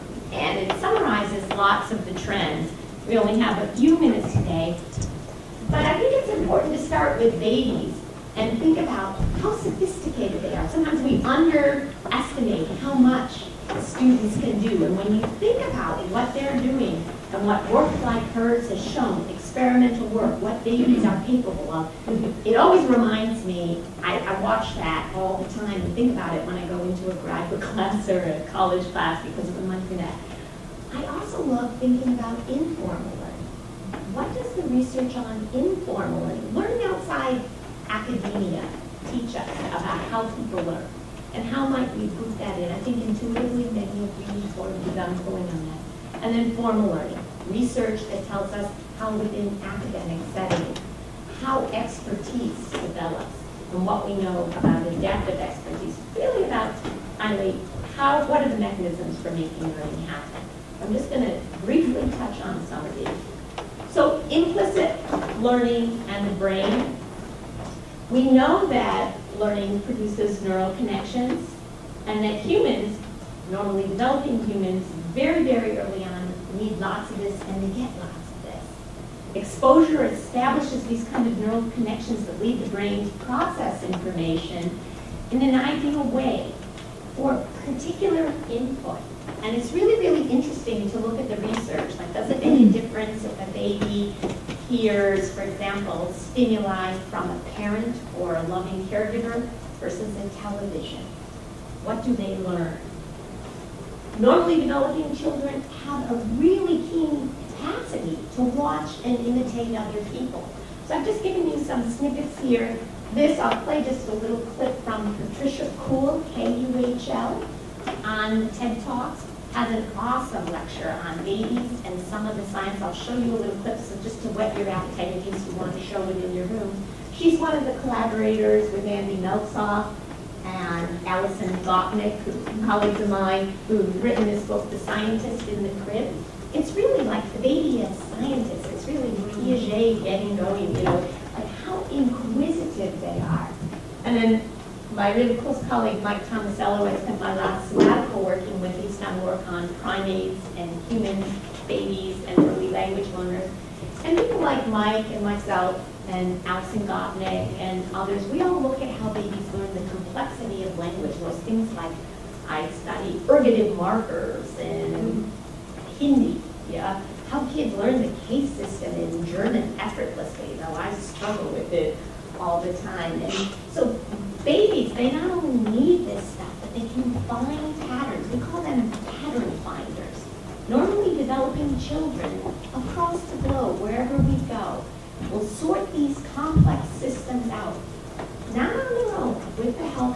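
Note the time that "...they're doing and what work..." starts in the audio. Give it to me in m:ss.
0:16.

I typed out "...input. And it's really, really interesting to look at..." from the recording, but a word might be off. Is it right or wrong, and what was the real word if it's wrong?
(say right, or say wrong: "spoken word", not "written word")
right.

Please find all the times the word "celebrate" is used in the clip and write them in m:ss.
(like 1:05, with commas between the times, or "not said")
not said.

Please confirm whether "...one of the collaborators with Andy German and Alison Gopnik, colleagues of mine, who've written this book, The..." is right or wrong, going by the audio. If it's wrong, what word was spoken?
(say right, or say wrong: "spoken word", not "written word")
wrong: "Meltzoff", not "German".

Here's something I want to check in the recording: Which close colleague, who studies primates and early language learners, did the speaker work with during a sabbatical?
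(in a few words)
Mike Tomasello.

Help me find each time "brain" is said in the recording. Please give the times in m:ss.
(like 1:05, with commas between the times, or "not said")
1:06, 1:22.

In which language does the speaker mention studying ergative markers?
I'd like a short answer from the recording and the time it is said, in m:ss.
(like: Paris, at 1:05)
Hindi, at 2:45.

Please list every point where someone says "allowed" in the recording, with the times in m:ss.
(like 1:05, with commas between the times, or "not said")
not said.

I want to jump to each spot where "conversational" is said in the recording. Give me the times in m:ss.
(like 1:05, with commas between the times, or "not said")
not said.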